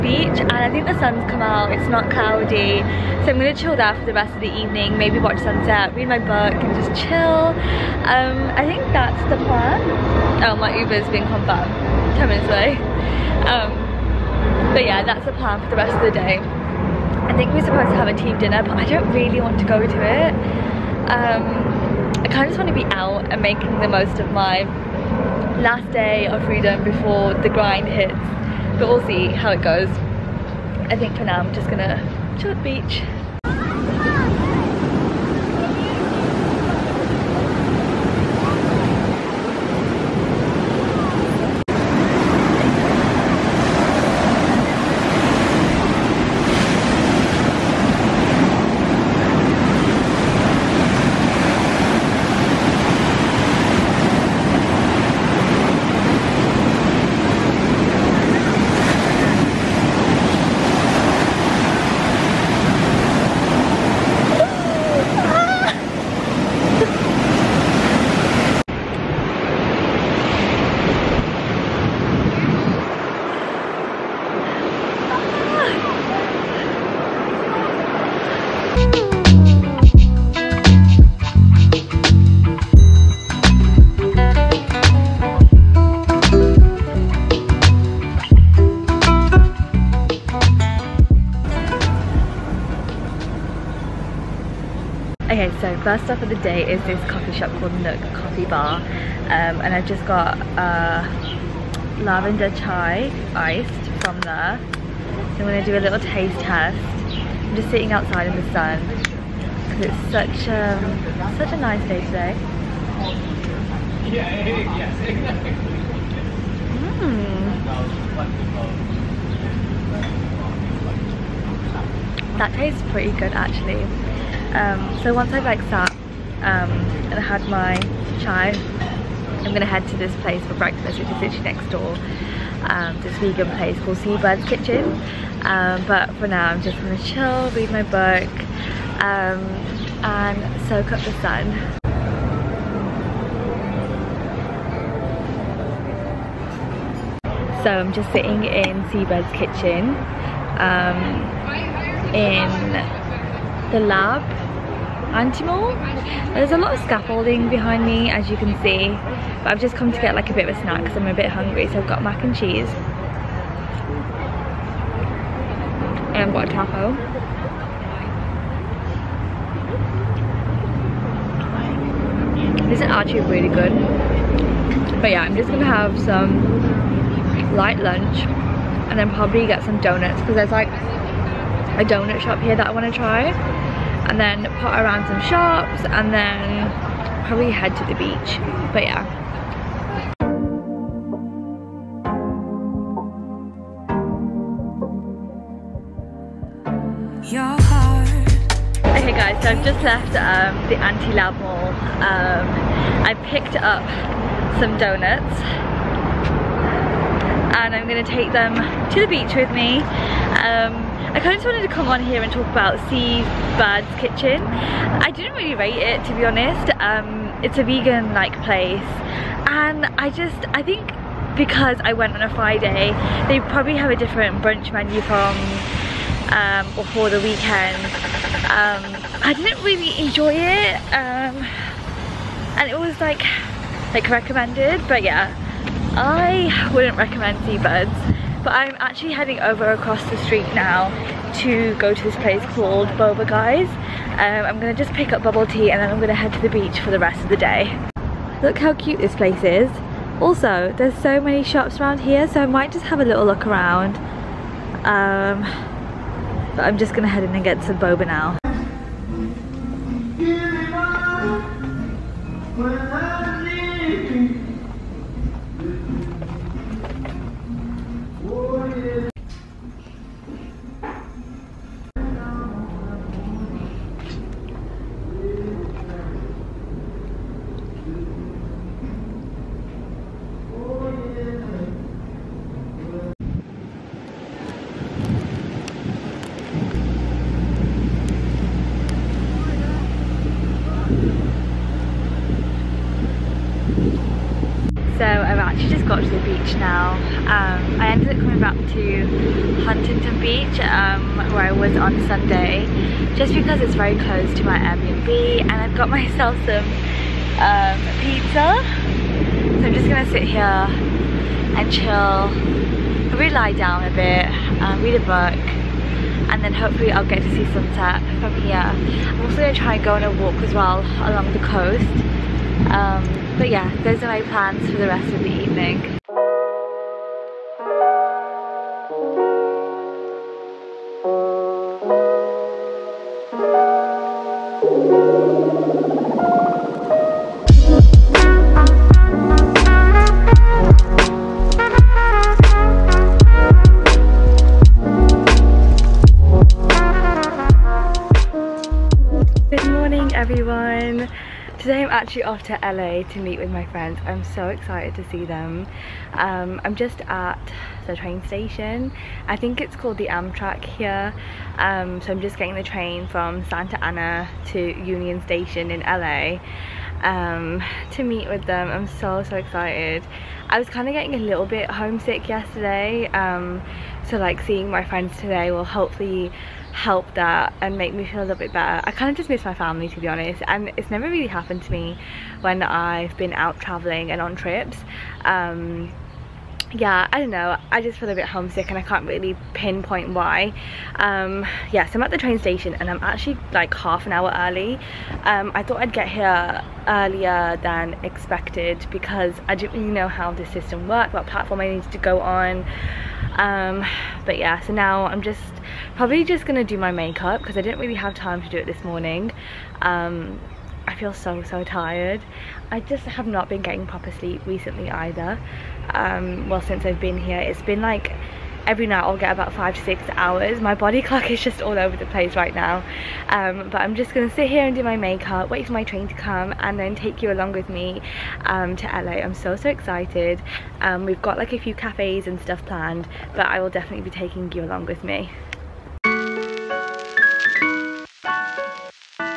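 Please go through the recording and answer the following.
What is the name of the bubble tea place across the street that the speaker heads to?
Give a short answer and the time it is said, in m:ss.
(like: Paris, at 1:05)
Boba Guys, at 4:02.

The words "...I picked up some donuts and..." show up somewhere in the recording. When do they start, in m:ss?
3:23.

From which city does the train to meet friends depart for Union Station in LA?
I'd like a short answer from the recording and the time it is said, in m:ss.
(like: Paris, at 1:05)
Santa Ana, at 6:03.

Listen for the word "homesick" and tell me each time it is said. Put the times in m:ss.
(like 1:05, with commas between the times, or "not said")
6:11, 6:28.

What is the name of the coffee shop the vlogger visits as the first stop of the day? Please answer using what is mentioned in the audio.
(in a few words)
Nook Coffee Bar.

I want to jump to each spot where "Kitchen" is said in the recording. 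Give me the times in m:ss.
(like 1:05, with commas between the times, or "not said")
2:14, 2:29, 3:33.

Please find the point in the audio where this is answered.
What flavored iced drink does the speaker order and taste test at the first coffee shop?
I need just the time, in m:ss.
1:42.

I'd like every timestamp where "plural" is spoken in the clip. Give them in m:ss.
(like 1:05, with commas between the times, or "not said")
not said.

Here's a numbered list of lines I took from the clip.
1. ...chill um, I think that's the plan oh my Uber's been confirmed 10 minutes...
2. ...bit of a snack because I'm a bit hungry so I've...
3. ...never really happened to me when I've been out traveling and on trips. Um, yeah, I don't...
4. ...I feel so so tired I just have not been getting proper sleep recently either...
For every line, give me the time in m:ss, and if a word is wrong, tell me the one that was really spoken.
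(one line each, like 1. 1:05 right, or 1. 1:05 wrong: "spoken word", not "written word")
1. 0:07 right
2. 2:40 right
3. 6:20 right
4. 6:50 right.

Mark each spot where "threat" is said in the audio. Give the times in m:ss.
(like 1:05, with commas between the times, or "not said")
not said.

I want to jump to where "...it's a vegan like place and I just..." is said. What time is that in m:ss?
3:37.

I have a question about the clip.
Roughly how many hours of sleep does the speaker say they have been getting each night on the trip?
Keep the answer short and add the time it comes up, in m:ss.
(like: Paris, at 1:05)
5 to 6, at 6:59.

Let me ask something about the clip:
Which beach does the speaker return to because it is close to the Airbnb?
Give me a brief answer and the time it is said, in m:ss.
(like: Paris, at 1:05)
Huntington Beach, at 4:59.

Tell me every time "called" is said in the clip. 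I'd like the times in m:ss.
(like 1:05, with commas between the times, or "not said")
1:37, 2:13, 4:02, 5:59.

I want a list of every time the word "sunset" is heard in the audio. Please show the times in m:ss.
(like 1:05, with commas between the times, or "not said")
0:05, 5:17.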